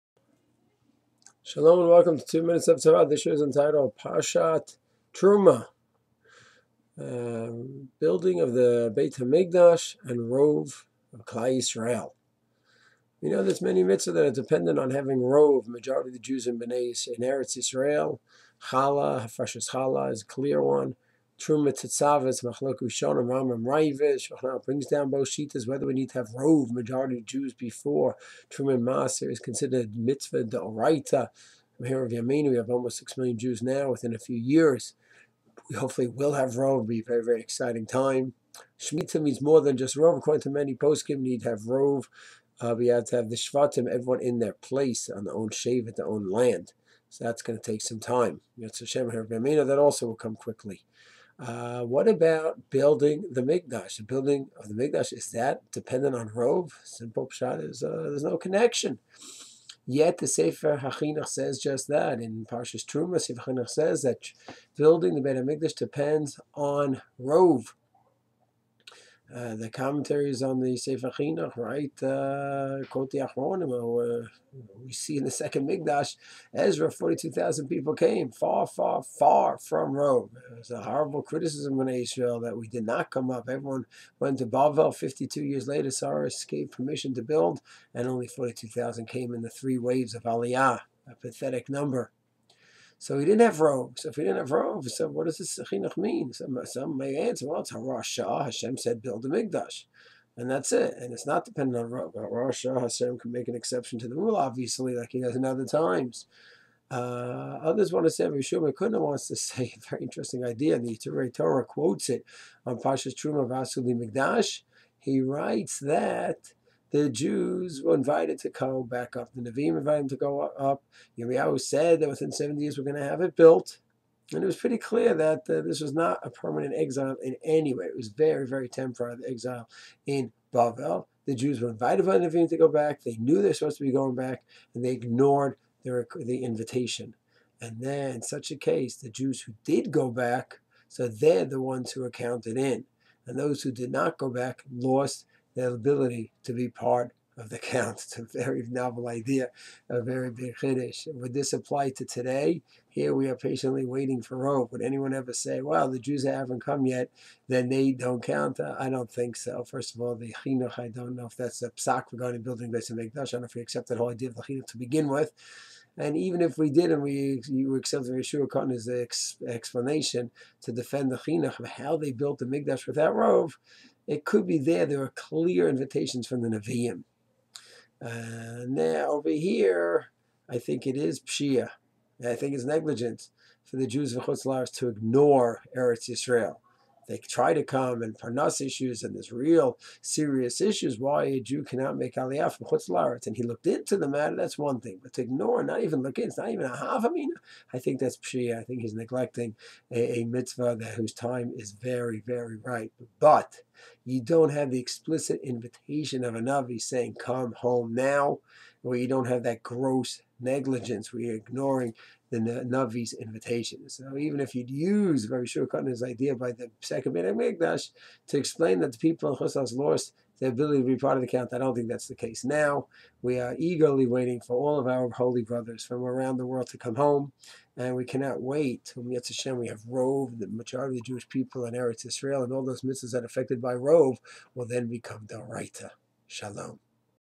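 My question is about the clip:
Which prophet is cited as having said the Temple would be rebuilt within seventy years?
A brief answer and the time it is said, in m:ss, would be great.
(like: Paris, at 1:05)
Yirmiyahu, at 2:01.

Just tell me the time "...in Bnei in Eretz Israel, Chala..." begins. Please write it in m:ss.
0:16.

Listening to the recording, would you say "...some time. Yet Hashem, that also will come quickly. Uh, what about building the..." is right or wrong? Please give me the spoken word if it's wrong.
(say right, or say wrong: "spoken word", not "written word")
right.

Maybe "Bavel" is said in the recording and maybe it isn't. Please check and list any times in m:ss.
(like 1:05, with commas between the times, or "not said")
1:24, 2:10.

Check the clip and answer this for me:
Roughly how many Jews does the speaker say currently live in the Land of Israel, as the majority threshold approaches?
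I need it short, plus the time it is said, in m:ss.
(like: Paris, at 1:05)
6 million, at 0:32.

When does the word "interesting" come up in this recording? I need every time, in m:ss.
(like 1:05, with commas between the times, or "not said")
1:50.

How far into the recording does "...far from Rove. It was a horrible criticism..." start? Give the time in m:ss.
1:19.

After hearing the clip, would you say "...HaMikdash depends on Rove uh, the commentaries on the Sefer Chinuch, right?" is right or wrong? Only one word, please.
right.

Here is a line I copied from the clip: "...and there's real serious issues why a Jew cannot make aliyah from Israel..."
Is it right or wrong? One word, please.
wrong.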